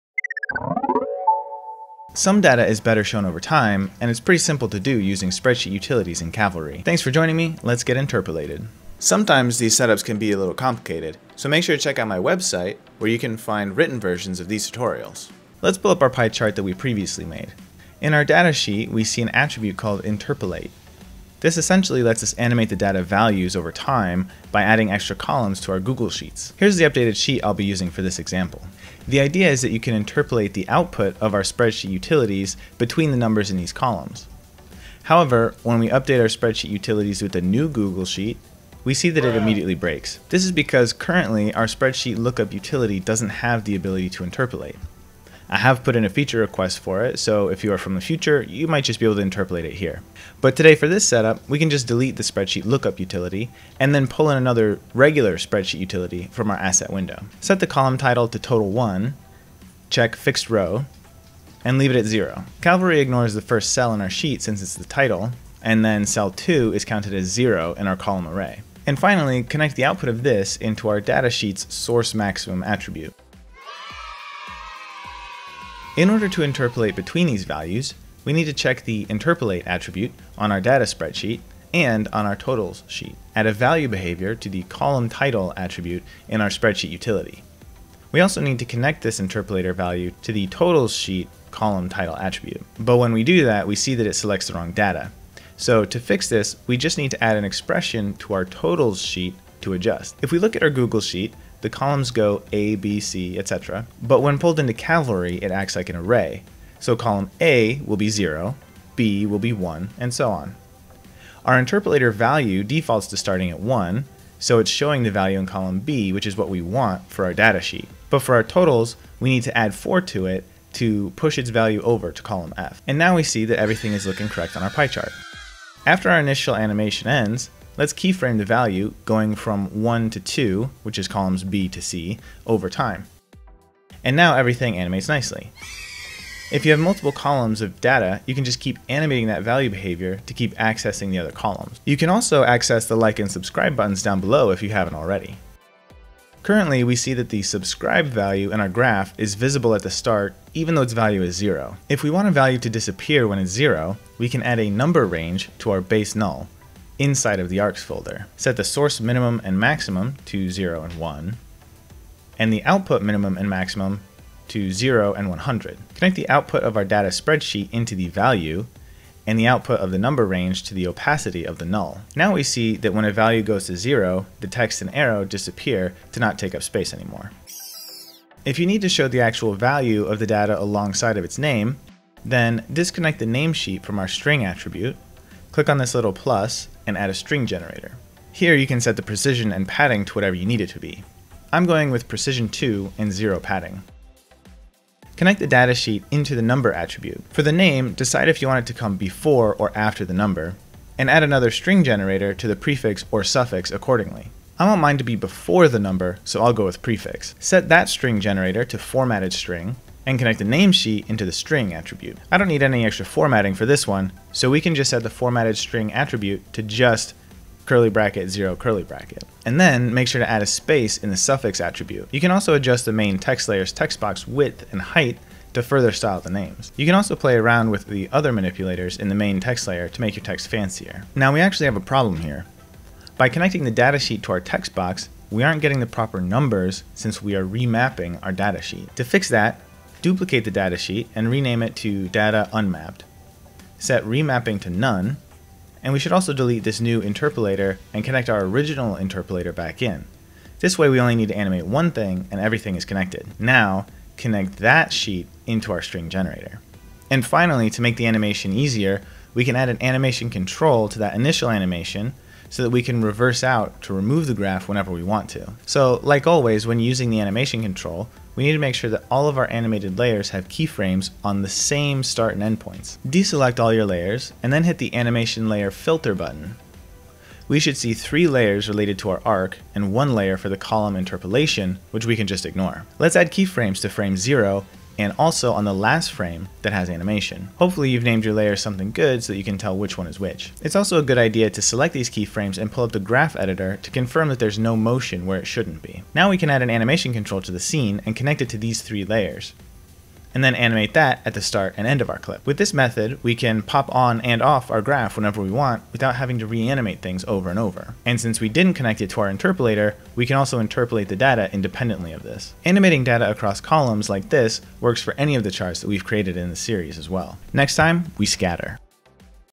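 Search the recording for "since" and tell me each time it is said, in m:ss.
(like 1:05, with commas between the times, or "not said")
1:04, 3:56, 5:08.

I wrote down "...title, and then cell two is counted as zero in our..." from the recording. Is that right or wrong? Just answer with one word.
right.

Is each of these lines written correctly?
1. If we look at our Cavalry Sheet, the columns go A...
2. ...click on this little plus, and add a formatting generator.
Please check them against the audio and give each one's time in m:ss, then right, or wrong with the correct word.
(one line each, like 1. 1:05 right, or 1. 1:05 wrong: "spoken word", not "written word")
1. 1:40 wrong: "Google", not "Cavalry"
2. 3:05 wrong: "string", not "formatting".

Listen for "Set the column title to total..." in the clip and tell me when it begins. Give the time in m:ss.
0:57.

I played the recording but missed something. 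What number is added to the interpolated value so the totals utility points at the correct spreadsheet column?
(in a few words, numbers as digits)
4.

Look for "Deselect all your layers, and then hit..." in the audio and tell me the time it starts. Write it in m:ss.
4:33.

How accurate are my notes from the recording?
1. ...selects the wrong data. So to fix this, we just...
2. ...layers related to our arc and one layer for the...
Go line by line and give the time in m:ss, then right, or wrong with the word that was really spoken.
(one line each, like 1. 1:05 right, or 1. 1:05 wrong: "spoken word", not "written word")
1. 1:34 right
2. 4:38 right.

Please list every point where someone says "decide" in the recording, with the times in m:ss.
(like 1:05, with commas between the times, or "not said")
3:17.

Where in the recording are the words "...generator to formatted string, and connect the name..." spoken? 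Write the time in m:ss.
3:28.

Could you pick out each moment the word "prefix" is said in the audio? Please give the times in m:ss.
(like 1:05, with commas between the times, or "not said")
3:22, 3:26.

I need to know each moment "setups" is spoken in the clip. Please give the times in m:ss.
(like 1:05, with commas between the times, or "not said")
0:09, 0:51.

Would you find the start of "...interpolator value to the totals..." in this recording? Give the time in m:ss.
1:29.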